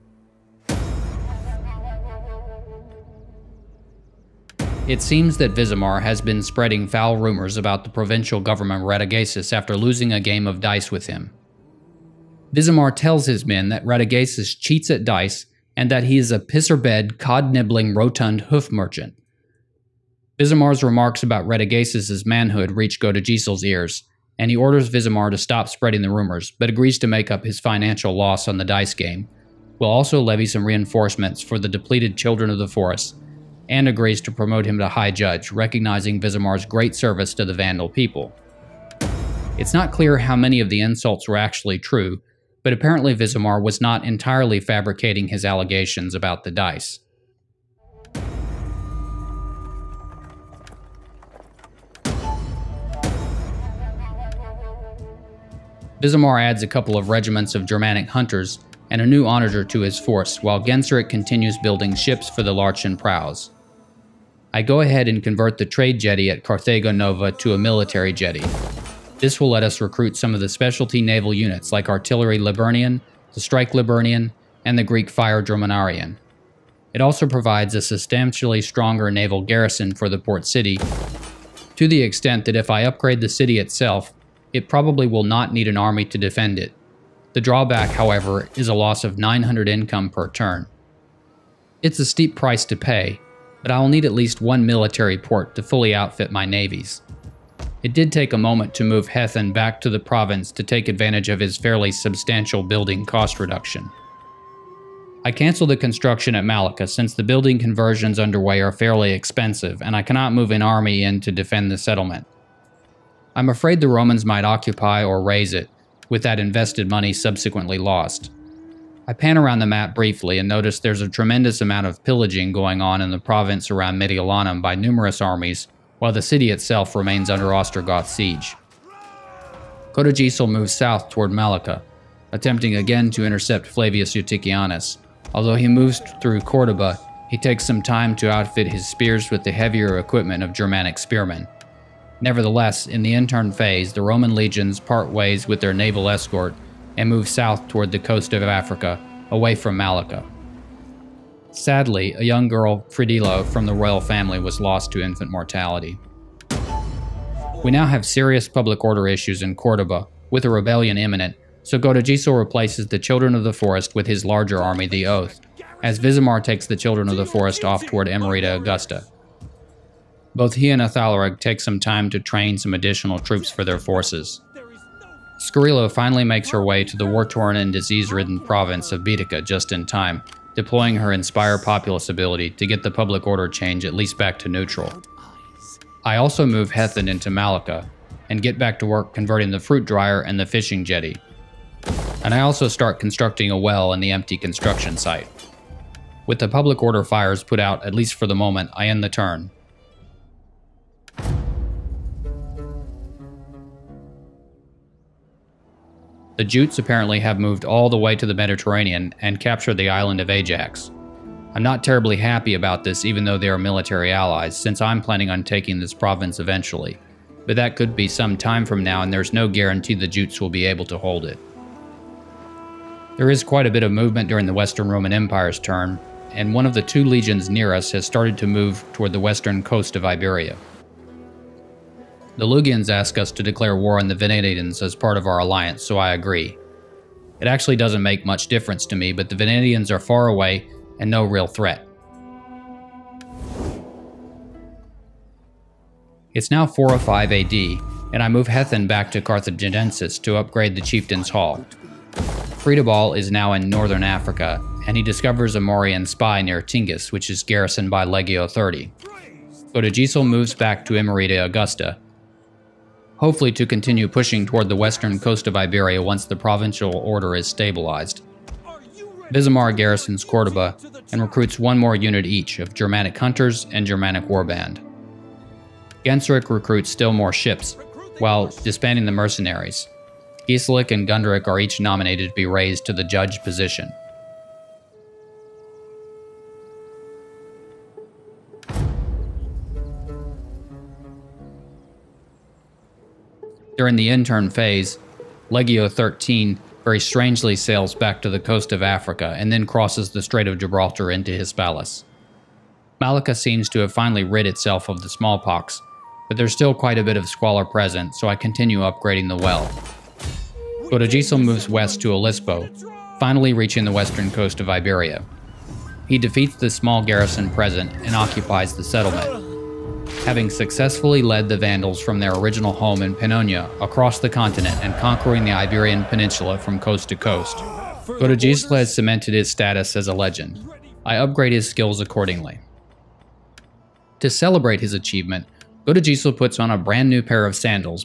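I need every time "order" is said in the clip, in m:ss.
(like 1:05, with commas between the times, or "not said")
0:24, 2:38, 3:03, 3:16, 4:26.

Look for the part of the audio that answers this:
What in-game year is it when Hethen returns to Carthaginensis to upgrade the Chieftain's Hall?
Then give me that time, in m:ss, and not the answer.
4:06.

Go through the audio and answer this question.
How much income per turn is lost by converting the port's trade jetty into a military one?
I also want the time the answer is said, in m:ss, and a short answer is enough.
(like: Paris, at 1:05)
900, at 1:29.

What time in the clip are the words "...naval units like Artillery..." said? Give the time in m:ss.
1:10.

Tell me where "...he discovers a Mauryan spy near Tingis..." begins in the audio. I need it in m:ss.
4:14.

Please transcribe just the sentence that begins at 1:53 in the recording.
I'm afraid the Romans might occupy or raise it, with that invested money subsequently lost.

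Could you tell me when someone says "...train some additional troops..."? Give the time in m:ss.
2:52.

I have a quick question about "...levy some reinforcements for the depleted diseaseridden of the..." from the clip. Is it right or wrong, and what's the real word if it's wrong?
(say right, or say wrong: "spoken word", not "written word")
wrong: "children", not "diseaseridden".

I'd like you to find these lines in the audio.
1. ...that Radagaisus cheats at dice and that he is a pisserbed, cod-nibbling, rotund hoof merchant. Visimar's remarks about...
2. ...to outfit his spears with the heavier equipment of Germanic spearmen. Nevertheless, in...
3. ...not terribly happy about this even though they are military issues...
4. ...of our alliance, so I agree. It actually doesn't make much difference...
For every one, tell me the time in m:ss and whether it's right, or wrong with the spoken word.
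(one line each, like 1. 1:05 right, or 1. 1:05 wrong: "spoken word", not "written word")
1. 0:13 right
2. 2:18 right
3. 3:31 wrong: "allies", not "issues"
4. 3:55 right.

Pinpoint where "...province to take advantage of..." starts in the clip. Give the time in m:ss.
1:39.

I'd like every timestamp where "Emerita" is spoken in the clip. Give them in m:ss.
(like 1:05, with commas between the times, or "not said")
2:48, 4:20.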